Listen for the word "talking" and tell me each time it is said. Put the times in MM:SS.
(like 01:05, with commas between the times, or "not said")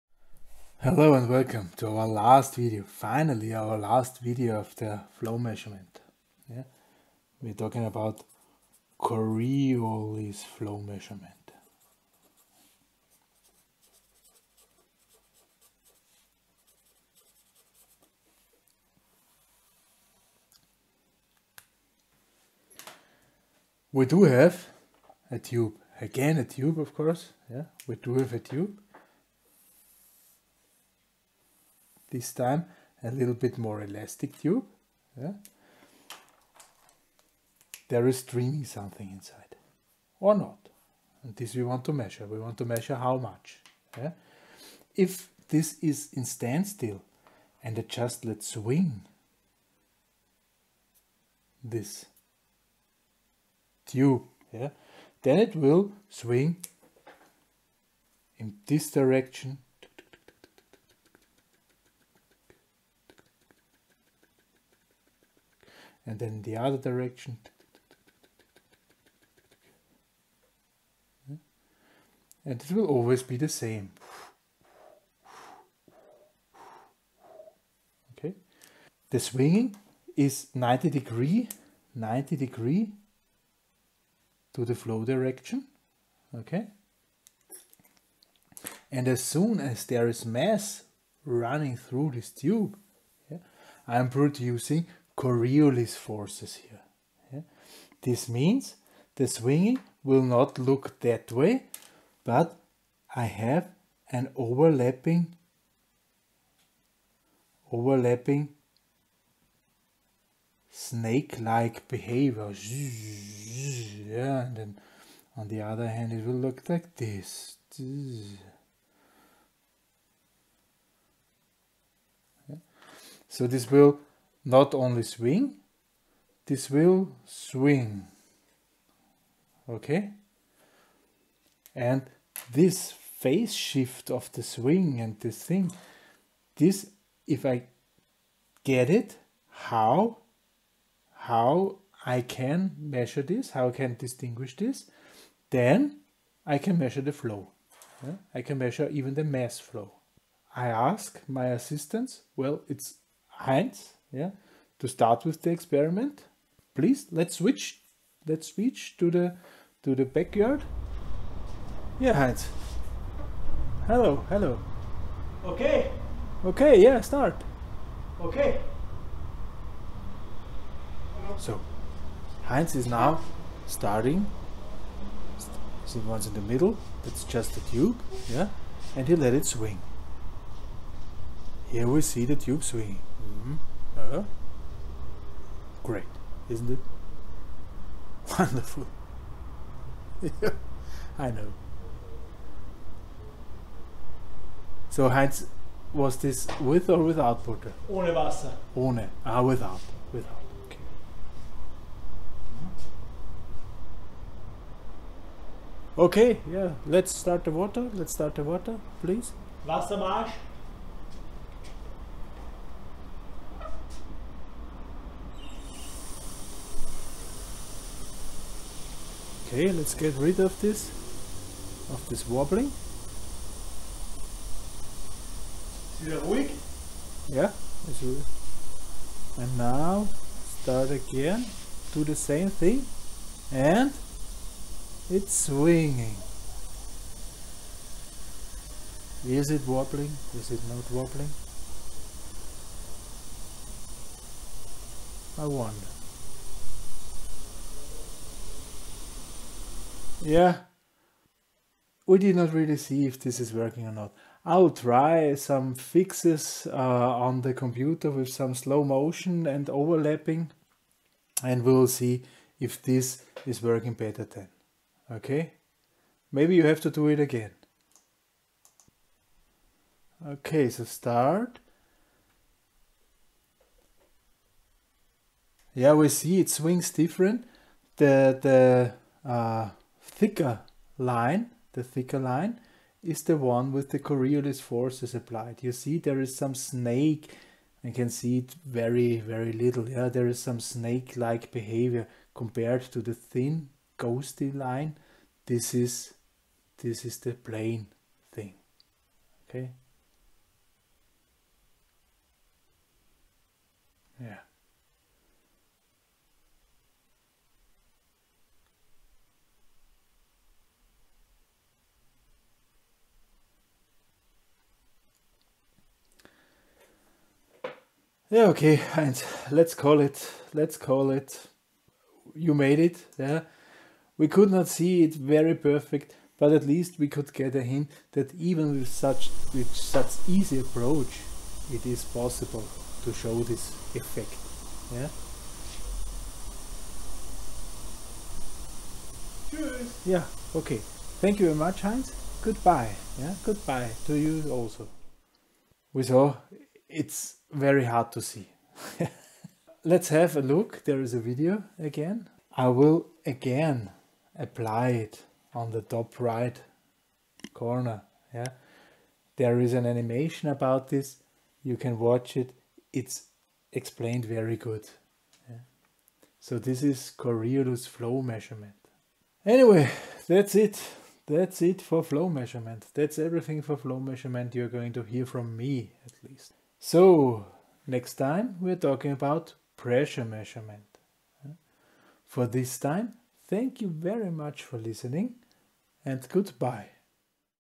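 00:07, 06:18.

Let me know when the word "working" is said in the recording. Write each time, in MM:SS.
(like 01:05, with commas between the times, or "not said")
04:13, 04:23.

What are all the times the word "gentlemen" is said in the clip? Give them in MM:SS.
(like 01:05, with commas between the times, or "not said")
not said.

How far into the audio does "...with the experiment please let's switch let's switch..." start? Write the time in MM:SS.
02:35.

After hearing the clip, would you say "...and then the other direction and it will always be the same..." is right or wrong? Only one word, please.
right.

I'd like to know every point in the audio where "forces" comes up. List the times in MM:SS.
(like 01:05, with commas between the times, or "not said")
01:35, 04:44.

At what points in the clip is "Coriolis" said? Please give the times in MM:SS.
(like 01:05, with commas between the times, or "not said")
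00:08, 01:35, 04:43, 06:07.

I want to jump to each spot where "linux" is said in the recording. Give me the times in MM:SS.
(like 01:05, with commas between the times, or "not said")
not said.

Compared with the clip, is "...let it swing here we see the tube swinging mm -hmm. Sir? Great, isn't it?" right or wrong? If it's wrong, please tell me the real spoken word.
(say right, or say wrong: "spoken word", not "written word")
right.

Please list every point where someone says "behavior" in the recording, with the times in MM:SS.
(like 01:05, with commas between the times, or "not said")
01:51, 04:51.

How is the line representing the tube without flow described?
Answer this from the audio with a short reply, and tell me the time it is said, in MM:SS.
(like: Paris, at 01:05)
Thin ghosty line, at 04:53.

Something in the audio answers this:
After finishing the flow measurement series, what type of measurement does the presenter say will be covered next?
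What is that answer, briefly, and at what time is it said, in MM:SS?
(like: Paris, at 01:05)
Pressure measurement, at 06:19.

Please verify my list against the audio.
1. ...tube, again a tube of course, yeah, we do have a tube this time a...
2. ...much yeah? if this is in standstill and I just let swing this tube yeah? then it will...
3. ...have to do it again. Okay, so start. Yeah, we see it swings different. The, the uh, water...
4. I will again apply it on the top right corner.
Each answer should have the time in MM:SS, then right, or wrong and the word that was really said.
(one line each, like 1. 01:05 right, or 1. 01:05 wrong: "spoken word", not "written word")
1. 00:25 right
2. 00:43 right
3. 04:26 wrong: "thicker", not "water"
4. 05:52 right.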